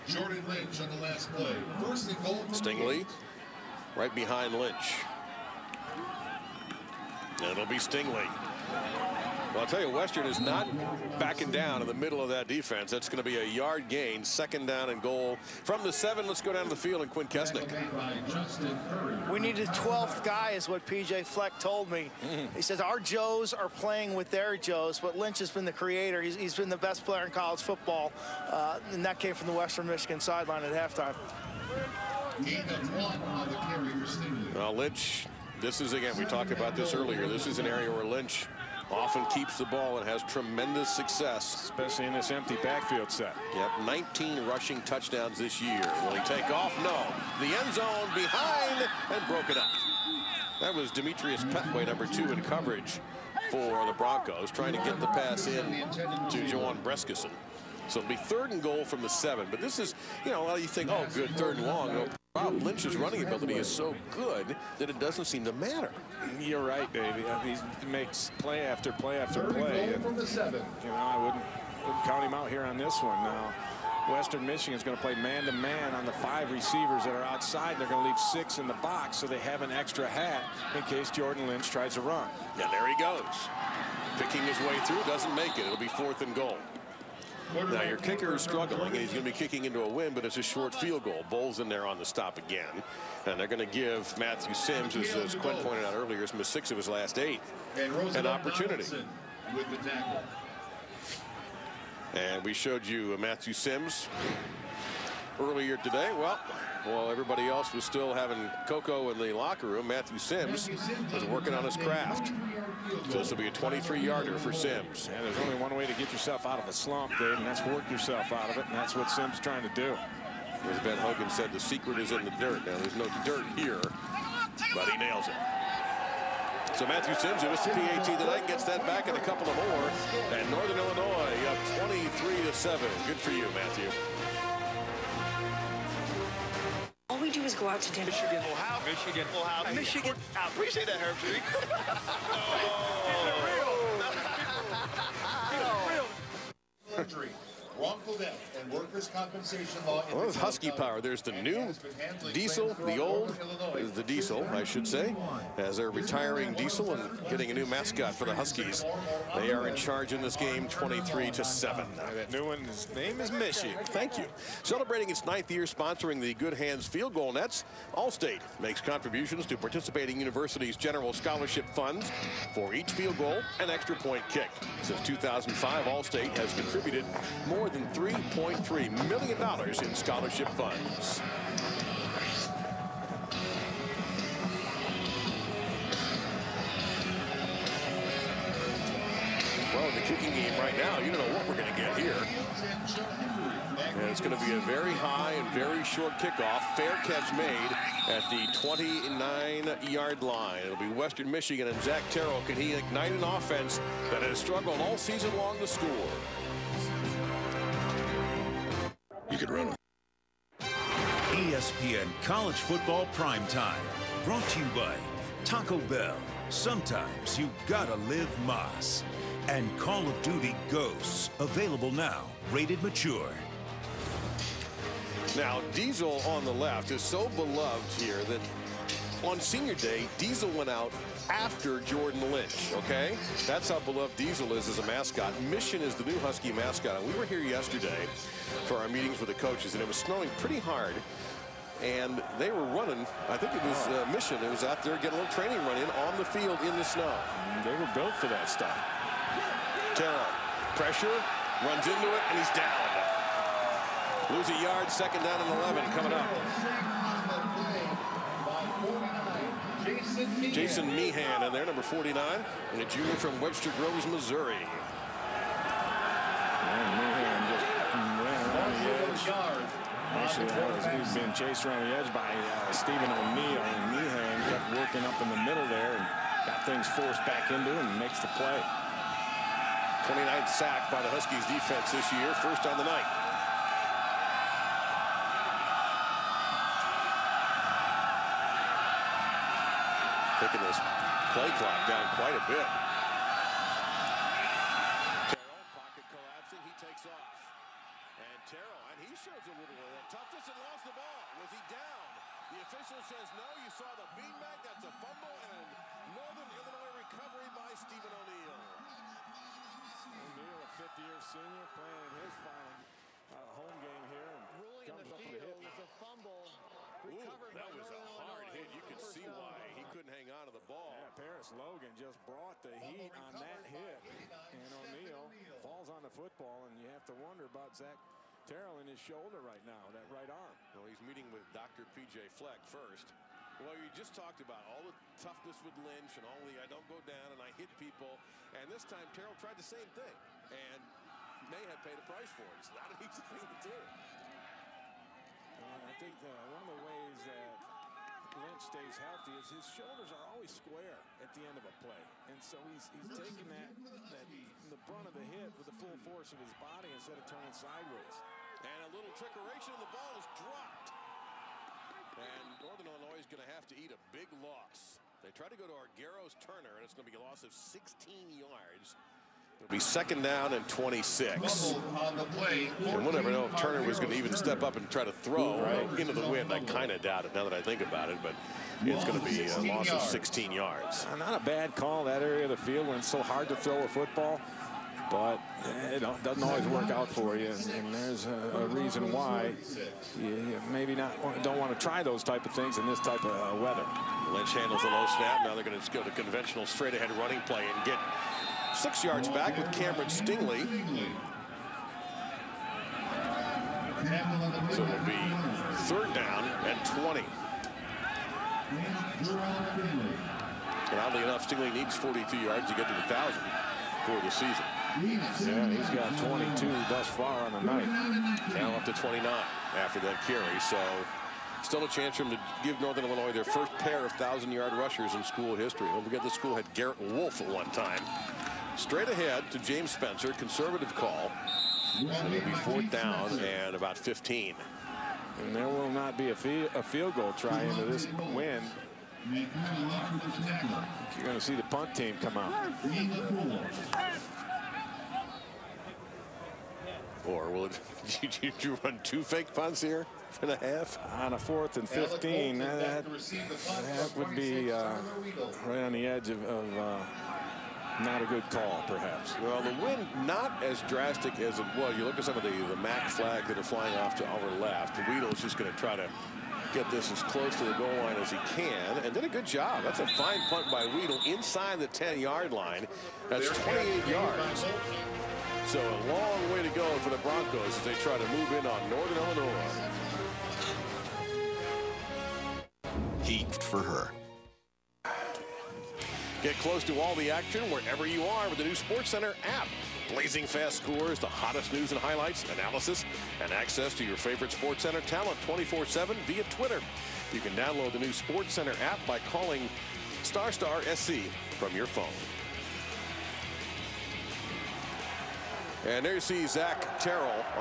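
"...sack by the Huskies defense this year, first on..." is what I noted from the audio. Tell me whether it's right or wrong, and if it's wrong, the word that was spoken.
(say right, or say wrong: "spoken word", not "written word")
right.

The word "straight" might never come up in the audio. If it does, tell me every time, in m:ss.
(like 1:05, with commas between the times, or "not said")
6:36, 7:08.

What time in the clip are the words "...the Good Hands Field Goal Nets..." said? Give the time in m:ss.
2:46.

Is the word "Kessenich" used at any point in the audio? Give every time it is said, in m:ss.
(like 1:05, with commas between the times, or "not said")
0:17.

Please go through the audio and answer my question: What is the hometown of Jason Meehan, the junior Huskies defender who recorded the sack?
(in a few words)
Webster Groves, Missouri.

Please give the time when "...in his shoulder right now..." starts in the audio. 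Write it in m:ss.
5:28.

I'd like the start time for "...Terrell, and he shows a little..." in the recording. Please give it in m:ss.
4:58.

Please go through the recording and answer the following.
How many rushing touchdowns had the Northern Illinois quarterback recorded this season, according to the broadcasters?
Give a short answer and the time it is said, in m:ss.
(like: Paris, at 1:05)
19, at 0:43.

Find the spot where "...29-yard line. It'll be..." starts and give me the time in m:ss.
3:18.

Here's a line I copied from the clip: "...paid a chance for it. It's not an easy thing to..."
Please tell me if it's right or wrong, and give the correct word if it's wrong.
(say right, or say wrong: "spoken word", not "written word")
wrong: "price", not "chance".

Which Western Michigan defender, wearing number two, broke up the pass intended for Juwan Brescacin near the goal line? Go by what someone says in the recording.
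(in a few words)
Demetrius Petway.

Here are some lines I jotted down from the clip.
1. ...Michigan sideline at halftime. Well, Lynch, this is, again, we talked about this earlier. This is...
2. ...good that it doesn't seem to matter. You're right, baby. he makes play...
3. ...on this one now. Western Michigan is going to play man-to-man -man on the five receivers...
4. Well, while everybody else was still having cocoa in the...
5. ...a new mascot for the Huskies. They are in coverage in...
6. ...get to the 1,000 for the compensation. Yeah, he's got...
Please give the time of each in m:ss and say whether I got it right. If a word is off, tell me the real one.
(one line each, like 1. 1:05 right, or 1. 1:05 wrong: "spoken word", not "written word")
1. 0:29 right
2. 1:04 right
3. 1:12 right
4. 1:46 right
5. 2:37 wrong: "charge", not "coverage"
6. 6:52 wrong: "season", not "compensation".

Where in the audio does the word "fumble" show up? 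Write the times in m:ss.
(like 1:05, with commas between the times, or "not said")
5:05, 5:15.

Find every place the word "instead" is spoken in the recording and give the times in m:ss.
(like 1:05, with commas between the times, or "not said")
5:56.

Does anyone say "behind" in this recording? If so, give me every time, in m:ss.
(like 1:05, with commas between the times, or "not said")
0:04, 0:48.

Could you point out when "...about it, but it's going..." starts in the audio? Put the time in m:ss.
6:17.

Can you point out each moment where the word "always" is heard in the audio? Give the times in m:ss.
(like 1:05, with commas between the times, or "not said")
5:50, 6:26.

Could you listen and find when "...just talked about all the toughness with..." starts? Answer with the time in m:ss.
5:33.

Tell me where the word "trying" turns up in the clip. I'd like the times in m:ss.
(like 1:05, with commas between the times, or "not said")
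0:54, 1:59.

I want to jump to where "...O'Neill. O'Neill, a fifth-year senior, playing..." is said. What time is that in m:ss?
5:08.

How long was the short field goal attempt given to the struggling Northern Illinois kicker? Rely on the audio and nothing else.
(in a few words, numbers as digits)
23 yards.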